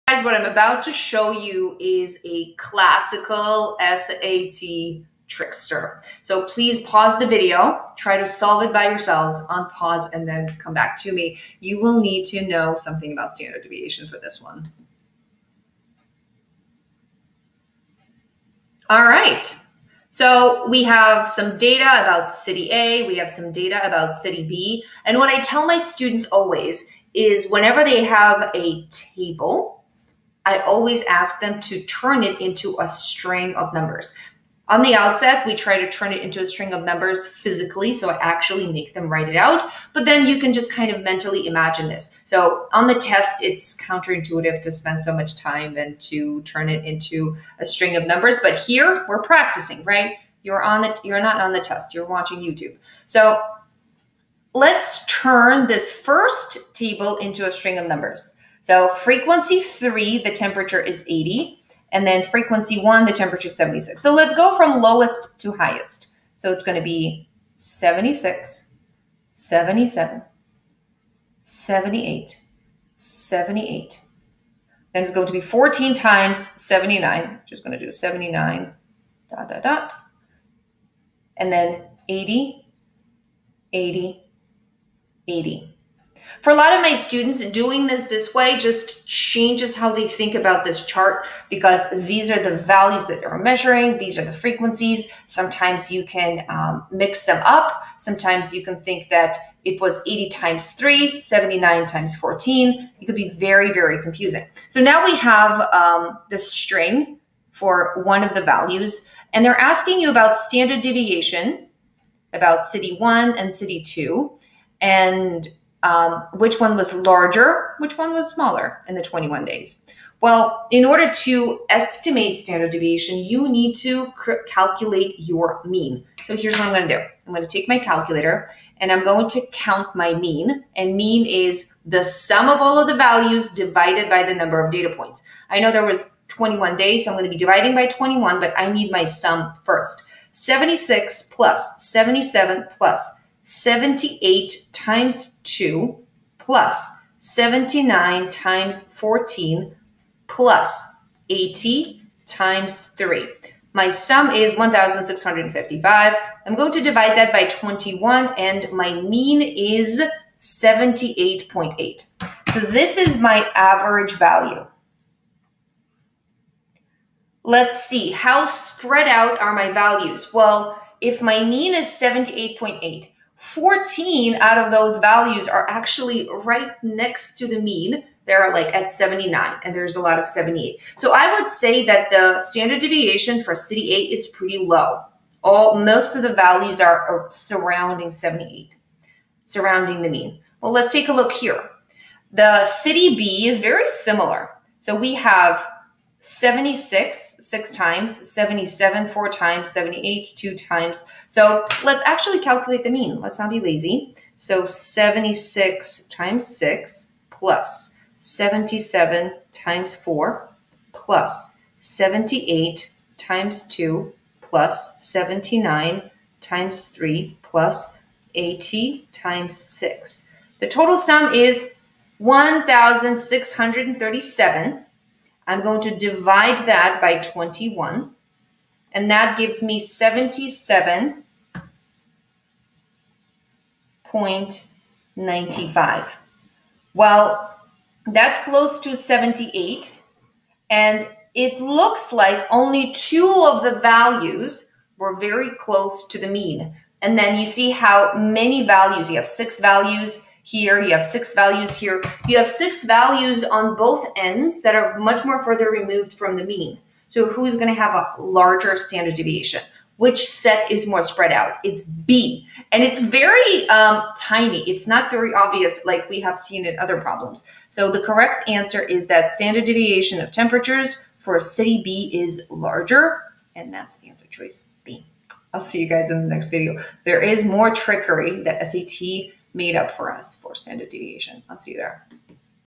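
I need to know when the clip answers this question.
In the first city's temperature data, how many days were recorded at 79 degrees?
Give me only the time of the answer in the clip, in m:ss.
1:15.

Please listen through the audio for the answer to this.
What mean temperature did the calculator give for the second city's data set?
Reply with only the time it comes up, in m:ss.
3:49.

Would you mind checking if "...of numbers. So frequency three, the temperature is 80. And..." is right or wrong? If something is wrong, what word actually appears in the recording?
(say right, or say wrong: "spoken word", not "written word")
right.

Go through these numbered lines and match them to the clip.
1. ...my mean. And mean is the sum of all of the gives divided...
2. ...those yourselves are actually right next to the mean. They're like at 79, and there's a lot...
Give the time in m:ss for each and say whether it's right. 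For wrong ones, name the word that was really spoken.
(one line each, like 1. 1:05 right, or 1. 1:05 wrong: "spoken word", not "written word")
1. 2:09 wrong: "values", not "gives"
2. 2:54 wrong: "values", not "yourselves".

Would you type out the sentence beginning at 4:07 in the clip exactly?
And then you see how many values, you have six values, here, you have six values here.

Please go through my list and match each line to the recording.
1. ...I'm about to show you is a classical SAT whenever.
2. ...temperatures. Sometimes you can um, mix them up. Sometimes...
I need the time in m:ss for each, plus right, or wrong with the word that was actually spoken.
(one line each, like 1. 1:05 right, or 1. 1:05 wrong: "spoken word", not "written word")
1. 0:00 wrong: "trickster", not "whenever"
2. 1:34 wrong: "frequencies", not "temperatures".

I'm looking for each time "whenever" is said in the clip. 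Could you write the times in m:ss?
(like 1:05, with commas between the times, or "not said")
0:27.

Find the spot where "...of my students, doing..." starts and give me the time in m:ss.
1:26.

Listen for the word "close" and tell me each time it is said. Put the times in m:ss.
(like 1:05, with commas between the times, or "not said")
3:58, 4:05.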